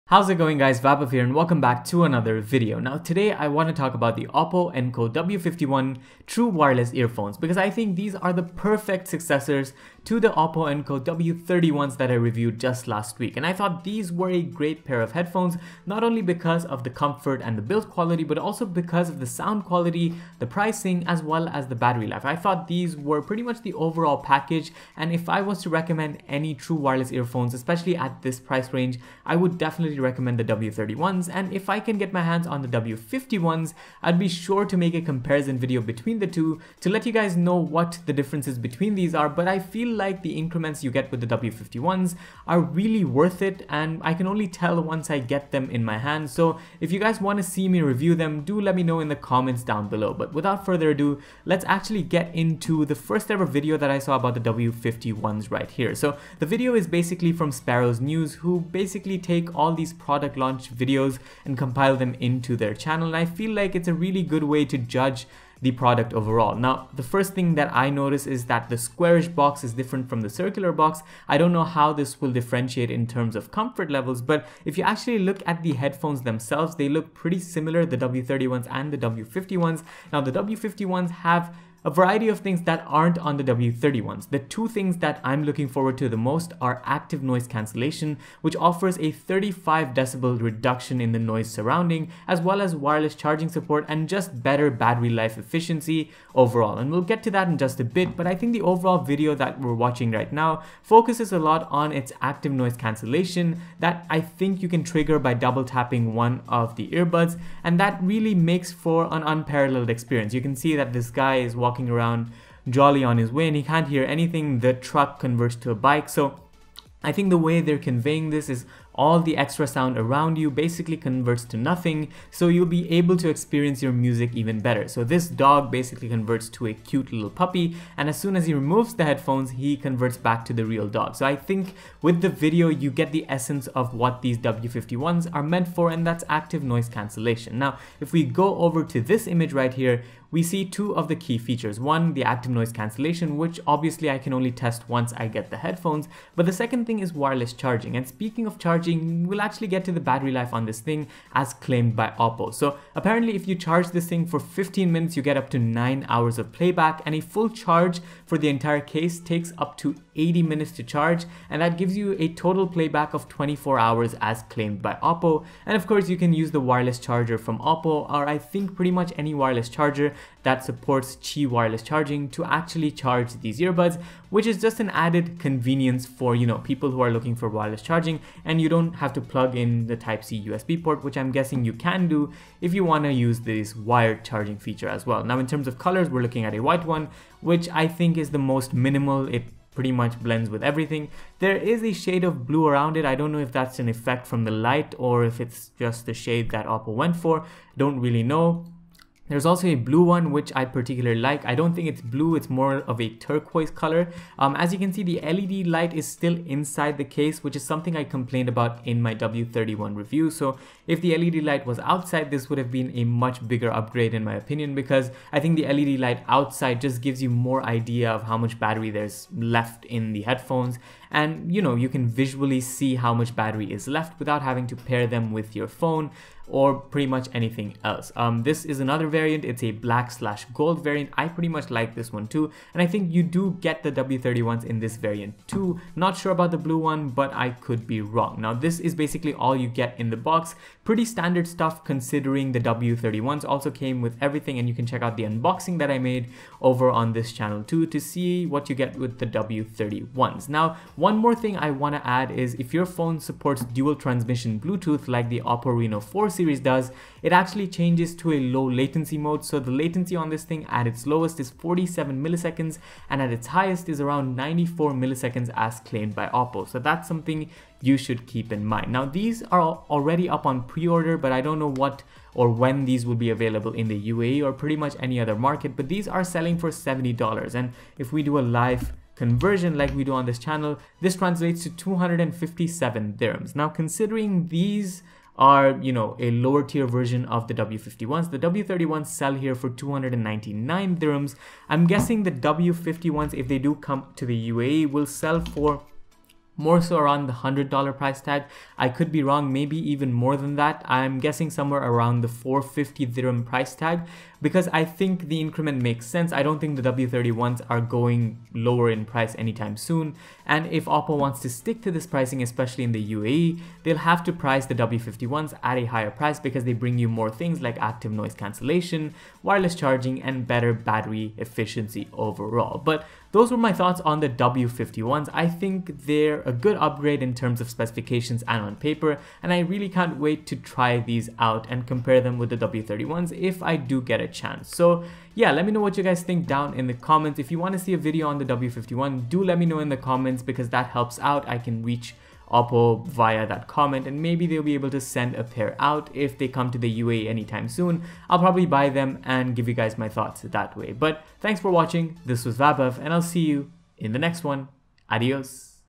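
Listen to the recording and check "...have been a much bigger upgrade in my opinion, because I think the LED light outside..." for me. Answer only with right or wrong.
right.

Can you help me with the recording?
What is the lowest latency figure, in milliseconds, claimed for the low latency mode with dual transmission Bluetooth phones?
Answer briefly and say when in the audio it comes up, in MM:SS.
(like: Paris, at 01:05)
47 milliseconds, at 04:21.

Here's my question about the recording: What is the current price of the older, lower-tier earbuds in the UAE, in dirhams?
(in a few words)
299 dirhams.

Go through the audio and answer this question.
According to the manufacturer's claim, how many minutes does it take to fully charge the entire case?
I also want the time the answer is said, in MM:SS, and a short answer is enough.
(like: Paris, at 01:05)
80 minutes, at 02:40.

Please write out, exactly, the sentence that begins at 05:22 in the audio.
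But those were my thoughts on the W51s.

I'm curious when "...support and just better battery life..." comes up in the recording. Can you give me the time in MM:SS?
01:33.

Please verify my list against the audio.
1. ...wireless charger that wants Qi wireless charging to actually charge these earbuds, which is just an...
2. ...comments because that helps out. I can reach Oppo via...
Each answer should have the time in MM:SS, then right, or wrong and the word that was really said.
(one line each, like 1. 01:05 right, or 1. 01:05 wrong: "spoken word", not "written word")
1. 02:49 wrong: "supports", not "wants"
2. 05:39 right.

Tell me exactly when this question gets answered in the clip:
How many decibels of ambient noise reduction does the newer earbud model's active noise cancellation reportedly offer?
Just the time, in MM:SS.
01:29.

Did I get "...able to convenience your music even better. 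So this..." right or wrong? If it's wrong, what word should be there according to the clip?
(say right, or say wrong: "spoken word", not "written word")
wrong: "experience", not "convenience".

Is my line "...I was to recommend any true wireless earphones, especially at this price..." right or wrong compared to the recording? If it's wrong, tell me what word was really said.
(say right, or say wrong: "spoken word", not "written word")
right.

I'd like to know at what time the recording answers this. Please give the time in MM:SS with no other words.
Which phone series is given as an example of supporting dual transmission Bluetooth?
04:15.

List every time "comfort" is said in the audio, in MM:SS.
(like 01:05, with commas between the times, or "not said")
00:16, 01:13.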